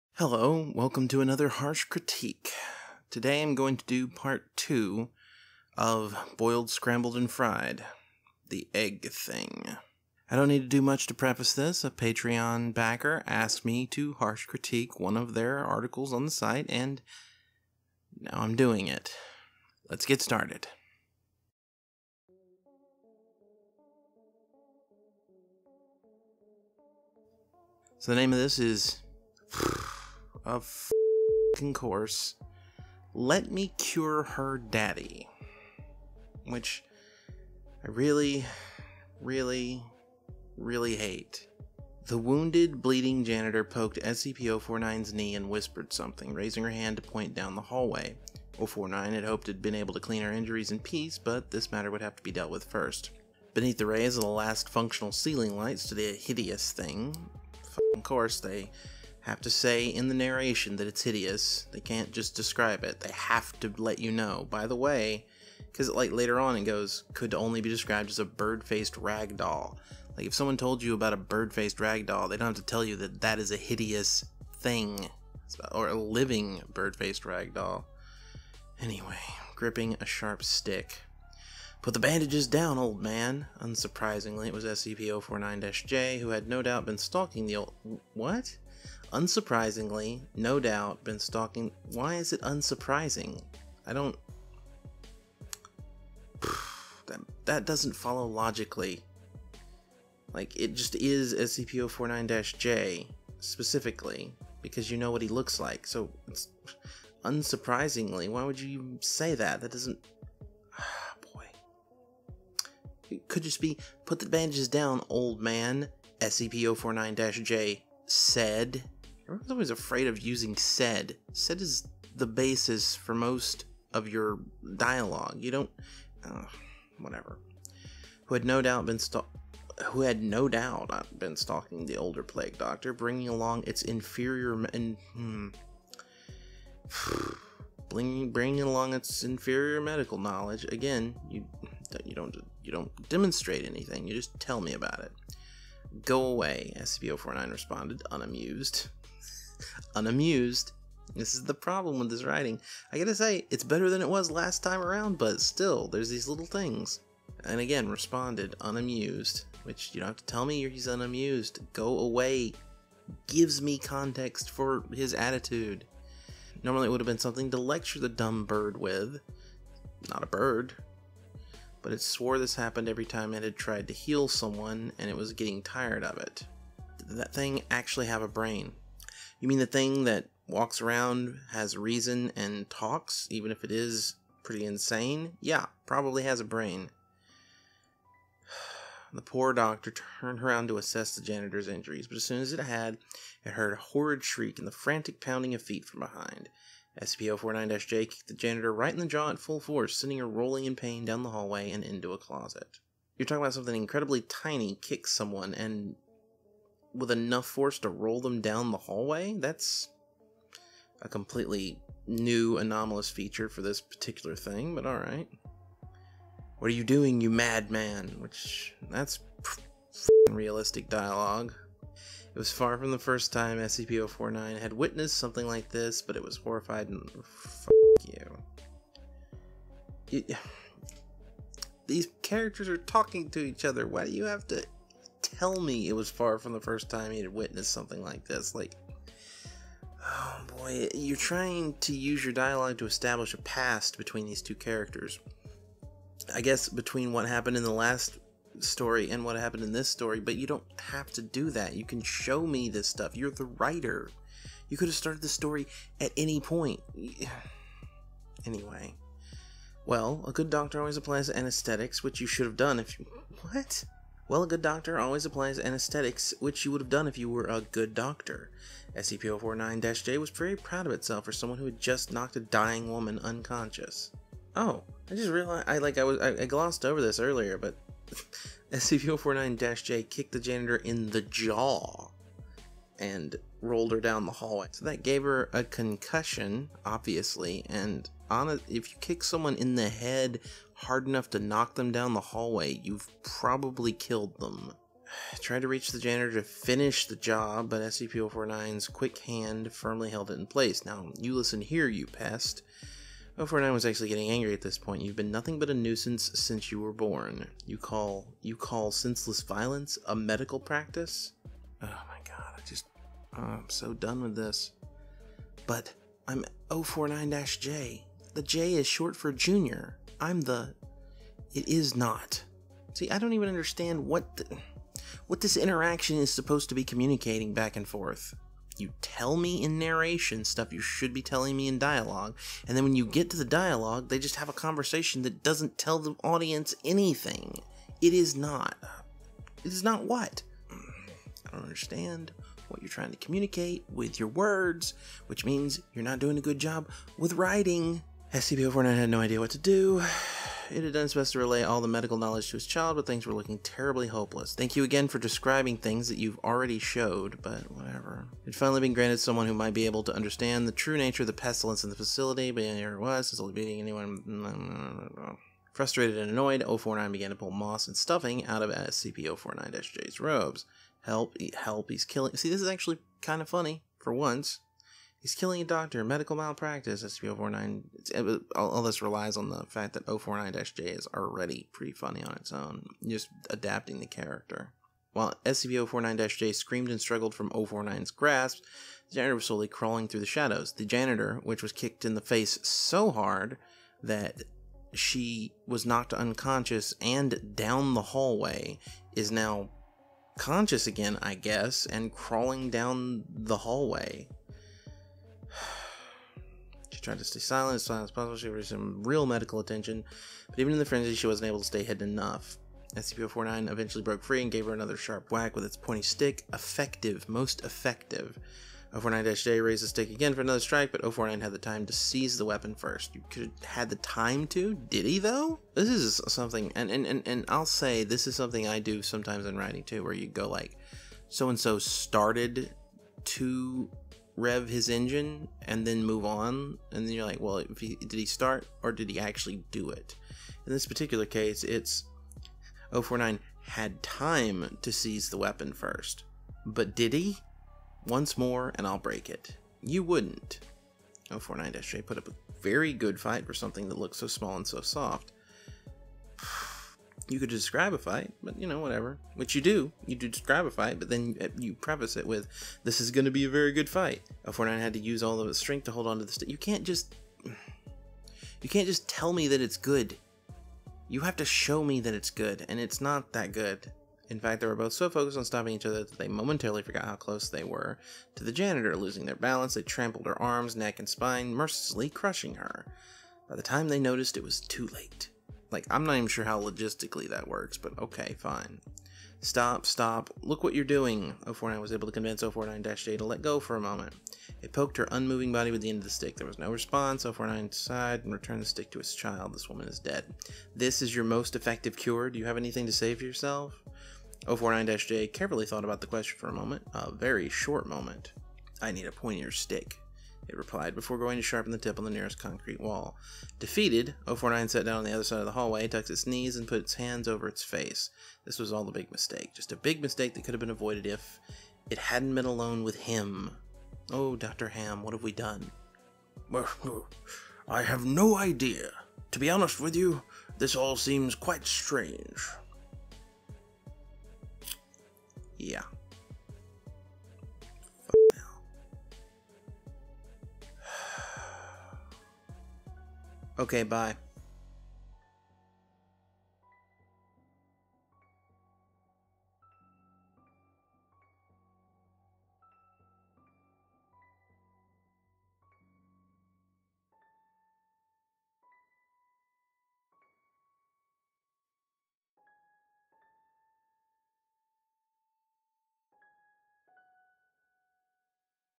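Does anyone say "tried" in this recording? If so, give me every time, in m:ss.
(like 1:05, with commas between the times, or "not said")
2:53, 4:55, 6:47.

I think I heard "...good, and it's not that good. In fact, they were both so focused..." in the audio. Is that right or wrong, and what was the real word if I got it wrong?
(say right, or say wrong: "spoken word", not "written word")
right.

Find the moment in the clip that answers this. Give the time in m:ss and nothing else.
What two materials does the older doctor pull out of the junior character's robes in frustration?
6:07.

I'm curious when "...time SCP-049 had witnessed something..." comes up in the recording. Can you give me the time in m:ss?
3:43.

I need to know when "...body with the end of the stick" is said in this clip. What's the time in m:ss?
8:15.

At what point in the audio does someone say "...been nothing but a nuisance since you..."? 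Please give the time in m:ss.
5:05.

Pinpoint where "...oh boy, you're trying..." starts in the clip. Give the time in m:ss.
4:00.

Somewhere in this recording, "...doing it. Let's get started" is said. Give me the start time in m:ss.
0:18.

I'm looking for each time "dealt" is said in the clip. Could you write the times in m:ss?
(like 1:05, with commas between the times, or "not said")
0:52.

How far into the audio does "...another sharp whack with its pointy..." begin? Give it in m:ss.
6:54.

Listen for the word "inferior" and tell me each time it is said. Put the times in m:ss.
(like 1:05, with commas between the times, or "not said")
2:13, 2:19.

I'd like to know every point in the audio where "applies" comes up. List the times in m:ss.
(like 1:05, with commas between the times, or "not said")
4:20, 4:25.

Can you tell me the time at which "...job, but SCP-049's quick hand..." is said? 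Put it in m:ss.
4:57.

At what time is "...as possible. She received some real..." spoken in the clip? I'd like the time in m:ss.
6:48.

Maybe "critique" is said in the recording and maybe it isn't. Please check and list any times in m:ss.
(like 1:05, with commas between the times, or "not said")
0:01, 0:14.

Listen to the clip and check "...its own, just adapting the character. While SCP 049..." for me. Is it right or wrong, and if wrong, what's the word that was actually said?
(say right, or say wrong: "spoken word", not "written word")
right.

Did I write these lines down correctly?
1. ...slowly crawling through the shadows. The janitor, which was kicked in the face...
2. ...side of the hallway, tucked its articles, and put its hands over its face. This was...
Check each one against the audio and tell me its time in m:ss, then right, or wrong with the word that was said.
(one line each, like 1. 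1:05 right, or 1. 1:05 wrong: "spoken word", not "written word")
1. 6:29 right
2. 8:35 wrong: "knees", not "articles".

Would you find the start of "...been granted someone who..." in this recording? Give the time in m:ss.
5:58.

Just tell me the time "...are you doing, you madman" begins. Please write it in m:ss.
3:36.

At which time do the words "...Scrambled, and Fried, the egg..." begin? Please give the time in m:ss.
0:06.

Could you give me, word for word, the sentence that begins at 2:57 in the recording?
Did that thing actually have a brain?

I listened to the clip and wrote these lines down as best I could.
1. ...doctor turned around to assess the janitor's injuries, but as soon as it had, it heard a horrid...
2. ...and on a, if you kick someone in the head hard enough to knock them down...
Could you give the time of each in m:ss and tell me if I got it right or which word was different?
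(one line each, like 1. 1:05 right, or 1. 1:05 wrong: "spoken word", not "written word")
1. 3:09 right
2. 4:47 right.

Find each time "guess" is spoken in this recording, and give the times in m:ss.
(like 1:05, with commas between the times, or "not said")
4:06, 6:41.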